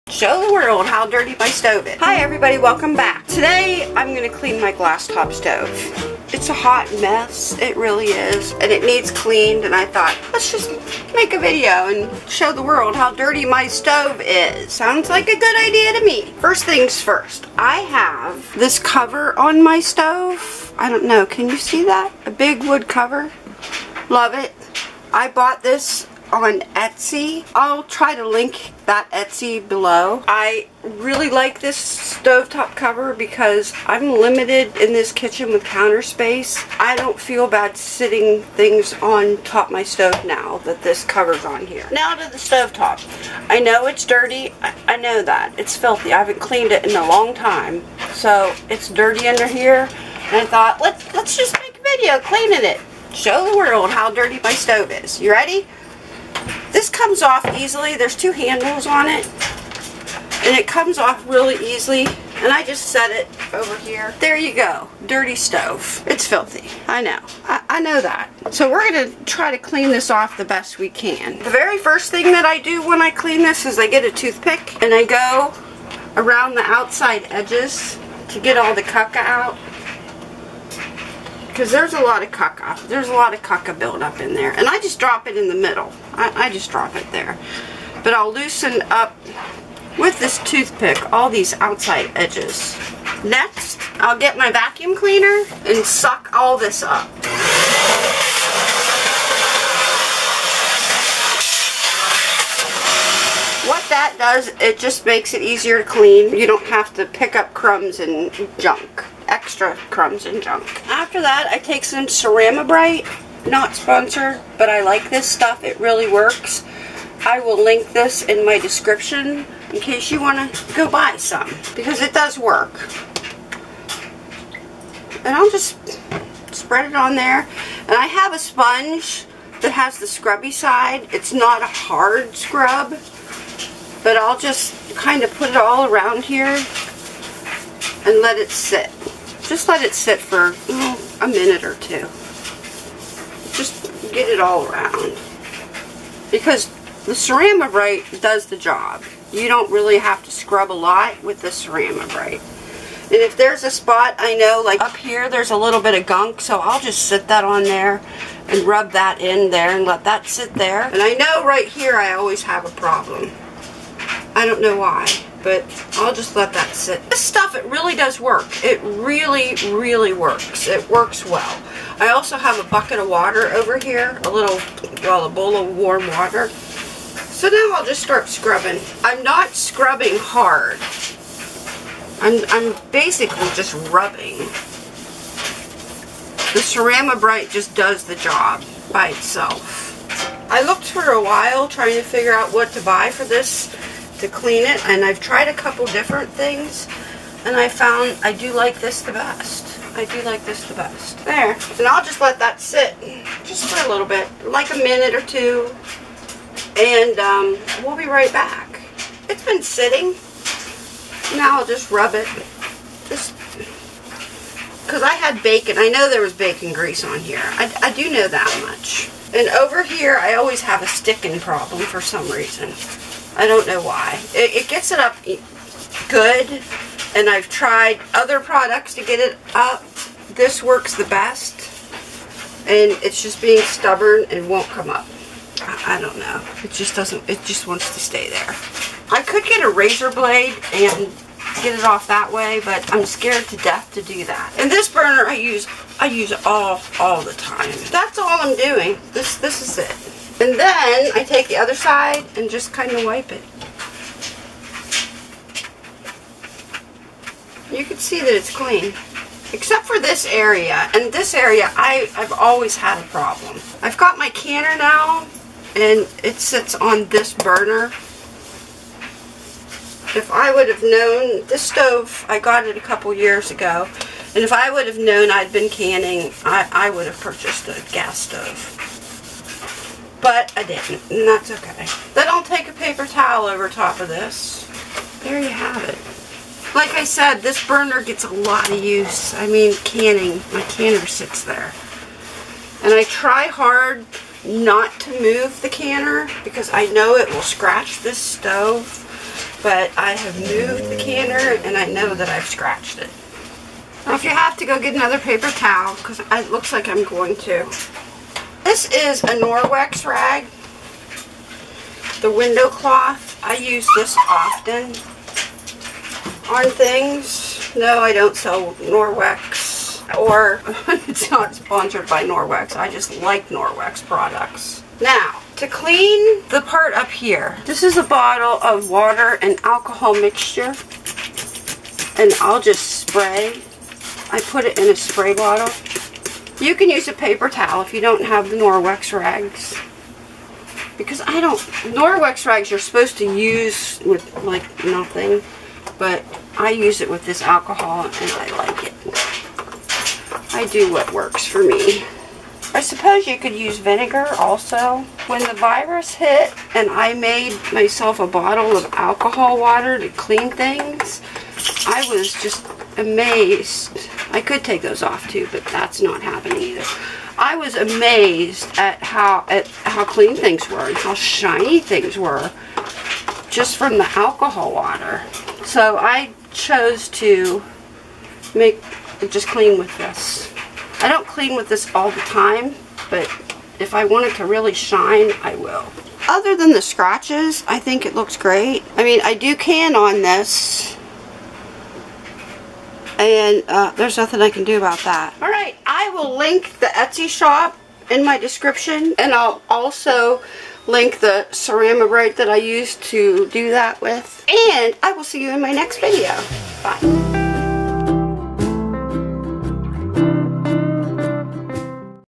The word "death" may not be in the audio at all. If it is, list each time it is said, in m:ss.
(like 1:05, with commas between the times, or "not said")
4:03.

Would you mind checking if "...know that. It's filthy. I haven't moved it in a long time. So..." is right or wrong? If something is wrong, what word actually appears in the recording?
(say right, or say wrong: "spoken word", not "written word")
wrong: "cleaned", not "moved".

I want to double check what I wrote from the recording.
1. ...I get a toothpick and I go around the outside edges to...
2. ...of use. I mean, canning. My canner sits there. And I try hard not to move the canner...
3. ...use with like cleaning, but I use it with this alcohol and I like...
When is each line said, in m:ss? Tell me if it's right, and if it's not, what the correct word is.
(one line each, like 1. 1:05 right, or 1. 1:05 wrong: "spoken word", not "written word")
1. 1:13 right
2. 4:48 right
3. 5:43 wrong: "nothing", not "cleaning".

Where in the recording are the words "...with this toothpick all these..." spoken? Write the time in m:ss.
1:29.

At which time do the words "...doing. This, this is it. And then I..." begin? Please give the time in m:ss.
4:08.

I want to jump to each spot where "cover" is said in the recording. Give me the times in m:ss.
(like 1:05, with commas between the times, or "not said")
0:18, 0:22, 0:32, 0:41.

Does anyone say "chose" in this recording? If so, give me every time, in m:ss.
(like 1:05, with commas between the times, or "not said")
6:16.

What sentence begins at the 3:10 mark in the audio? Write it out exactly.
I looked for a while trying to figure out what to buy for this to clean it.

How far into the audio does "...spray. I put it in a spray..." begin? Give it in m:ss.
5:33.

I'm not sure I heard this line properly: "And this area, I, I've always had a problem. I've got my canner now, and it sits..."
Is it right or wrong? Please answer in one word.
right.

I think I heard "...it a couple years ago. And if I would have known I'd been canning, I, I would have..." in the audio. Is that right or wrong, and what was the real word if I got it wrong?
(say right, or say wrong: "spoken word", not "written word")
right.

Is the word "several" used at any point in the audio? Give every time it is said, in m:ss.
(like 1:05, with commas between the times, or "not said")
not said.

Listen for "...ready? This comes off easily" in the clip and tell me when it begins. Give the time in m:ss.
0:55.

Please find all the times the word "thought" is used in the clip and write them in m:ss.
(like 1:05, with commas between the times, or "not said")
0:09, 0:50.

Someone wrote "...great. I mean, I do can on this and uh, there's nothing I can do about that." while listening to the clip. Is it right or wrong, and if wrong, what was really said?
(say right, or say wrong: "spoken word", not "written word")
right.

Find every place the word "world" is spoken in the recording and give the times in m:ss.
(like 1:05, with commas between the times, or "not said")
0:00, 0:12, 0:53.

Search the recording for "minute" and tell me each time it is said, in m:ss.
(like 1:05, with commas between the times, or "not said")
2:21, 3:24.